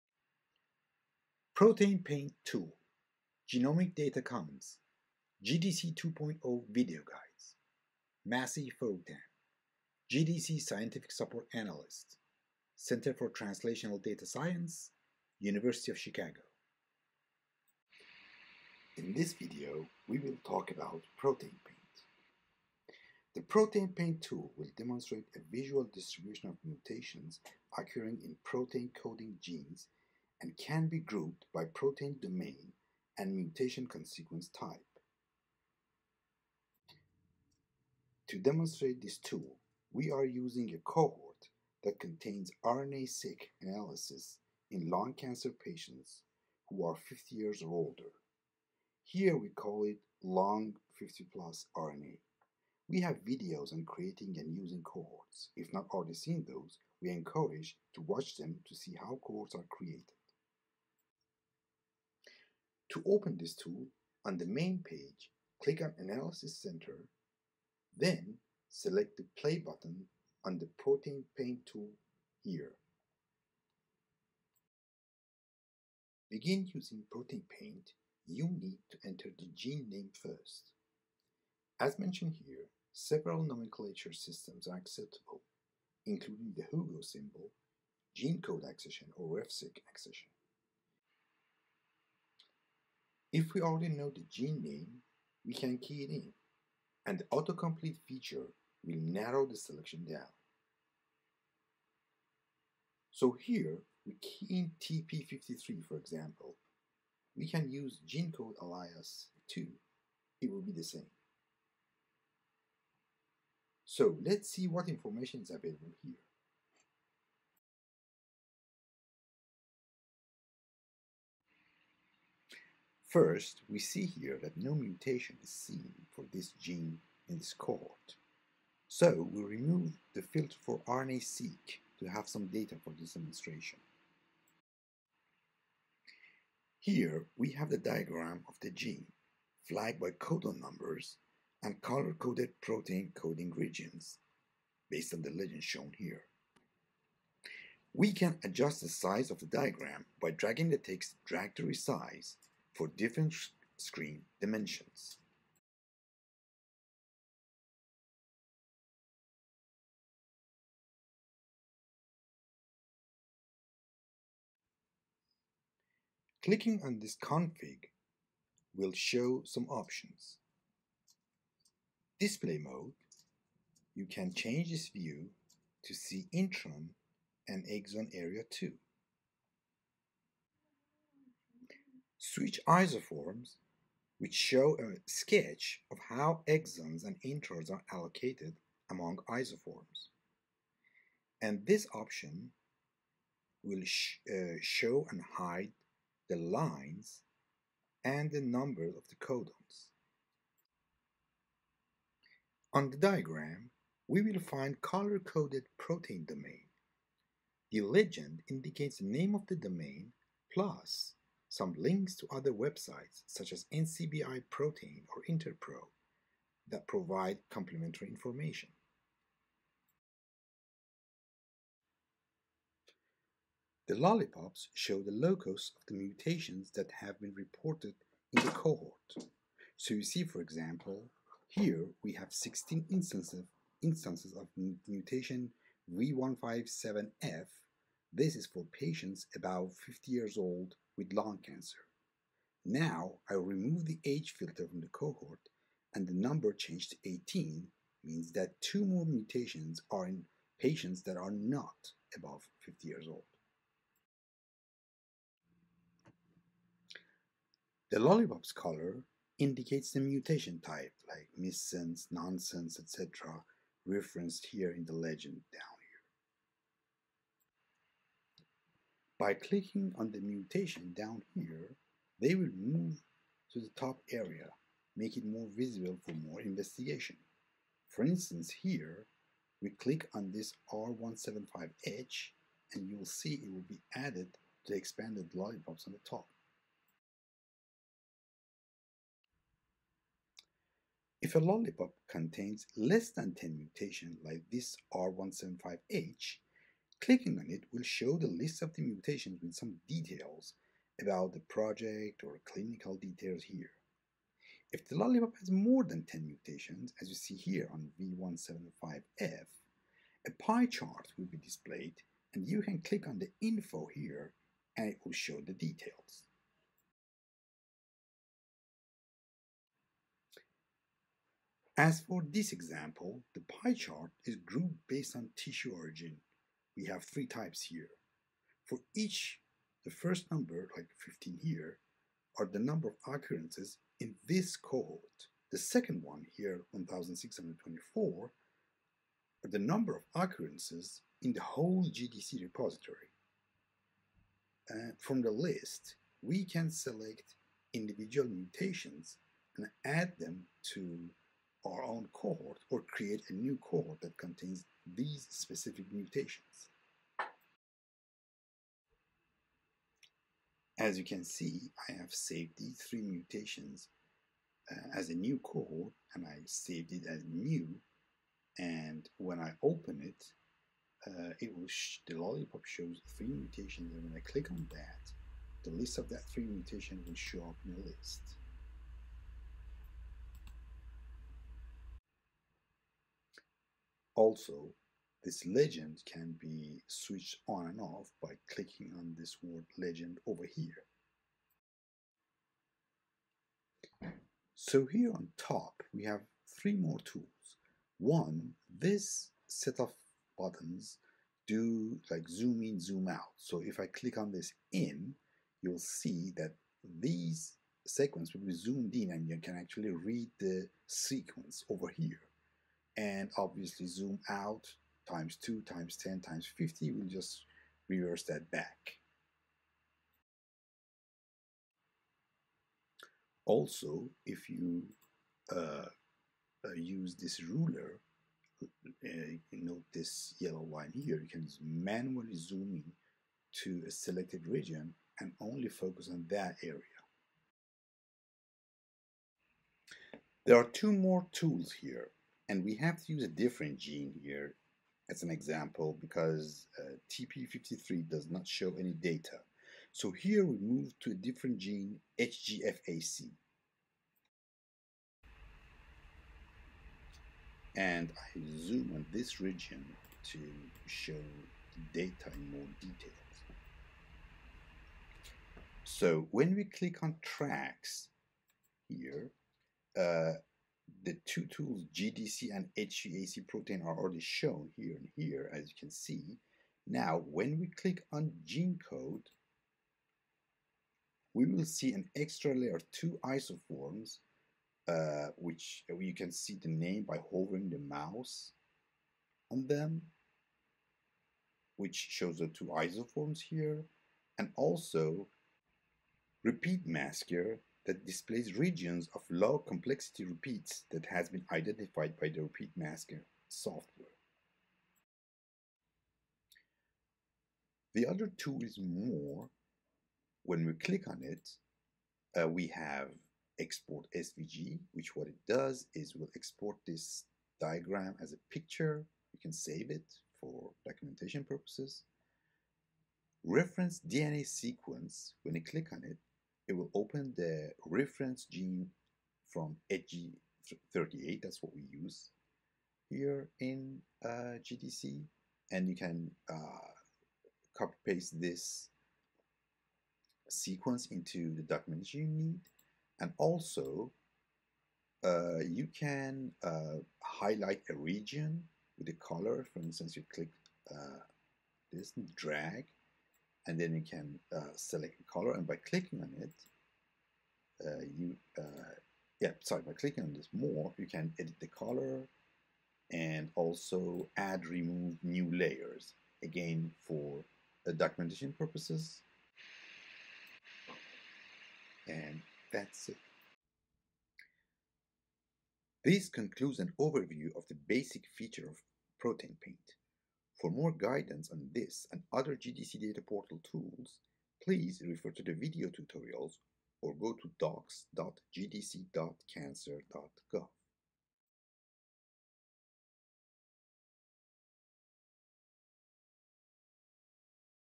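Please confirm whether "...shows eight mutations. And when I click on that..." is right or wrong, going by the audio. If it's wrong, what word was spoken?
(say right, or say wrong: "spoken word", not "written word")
wrong: "three", not "eight".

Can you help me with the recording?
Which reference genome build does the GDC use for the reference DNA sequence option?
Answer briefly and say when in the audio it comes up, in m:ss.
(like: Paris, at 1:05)
hg38, at 8:49.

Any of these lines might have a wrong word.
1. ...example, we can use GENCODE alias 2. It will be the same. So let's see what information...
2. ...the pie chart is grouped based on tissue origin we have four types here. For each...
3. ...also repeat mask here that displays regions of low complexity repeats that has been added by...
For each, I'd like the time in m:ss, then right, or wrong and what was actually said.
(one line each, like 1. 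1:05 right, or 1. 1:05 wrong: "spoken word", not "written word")
1. 1:45 right
2. 5:23 wrong: "three", not "four"
3. 8:14 wrong: "identified", not "added".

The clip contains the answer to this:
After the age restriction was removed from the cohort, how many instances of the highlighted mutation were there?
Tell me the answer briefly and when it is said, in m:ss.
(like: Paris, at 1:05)
18, at 4:07.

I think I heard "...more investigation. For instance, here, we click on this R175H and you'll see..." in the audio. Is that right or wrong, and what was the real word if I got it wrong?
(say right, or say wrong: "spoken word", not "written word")
right.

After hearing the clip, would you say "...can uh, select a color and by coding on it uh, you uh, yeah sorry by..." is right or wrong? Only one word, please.
wrong.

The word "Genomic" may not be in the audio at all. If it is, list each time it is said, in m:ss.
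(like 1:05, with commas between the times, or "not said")
0:03.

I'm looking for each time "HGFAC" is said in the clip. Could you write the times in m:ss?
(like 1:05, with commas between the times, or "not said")
7:32, 7:52.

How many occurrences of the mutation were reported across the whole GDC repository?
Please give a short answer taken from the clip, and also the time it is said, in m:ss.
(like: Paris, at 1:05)
1624, at 5:36.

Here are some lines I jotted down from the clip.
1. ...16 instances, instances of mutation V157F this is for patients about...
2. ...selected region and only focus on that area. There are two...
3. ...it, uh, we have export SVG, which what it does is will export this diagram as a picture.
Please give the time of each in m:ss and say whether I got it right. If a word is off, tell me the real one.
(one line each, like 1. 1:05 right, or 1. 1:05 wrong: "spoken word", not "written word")
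1. 3:52 right
2. 7:13 right
3. 8:31 right.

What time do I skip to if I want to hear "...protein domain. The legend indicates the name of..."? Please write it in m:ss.
3:25.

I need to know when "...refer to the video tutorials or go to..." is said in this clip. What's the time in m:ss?
9:45.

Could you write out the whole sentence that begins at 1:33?
If we already know the gene name, we can key it in, and the autocomplete feature will narrow the selection down.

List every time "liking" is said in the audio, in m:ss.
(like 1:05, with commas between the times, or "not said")
not said.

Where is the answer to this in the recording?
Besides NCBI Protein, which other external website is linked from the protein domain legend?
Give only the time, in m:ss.
3:35.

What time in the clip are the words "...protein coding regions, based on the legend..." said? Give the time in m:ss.
2:22.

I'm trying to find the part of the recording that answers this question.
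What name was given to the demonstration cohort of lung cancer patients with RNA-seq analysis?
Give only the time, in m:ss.
0:50.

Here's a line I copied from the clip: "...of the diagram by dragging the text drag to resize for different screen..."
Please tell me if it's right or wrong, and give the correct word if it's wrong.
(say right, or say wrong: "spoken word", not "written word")
right.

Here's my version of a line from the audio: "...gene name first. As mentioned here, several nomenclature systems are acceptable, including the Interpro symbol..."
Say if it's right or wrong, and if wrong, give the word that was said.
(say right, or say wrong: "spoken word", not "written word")
wrong: "Hugo", not "Interpro".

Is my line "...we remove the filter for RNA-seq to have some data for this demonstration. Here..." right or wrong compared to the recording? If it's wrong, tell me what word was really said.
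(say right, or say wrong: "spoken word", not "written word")
right.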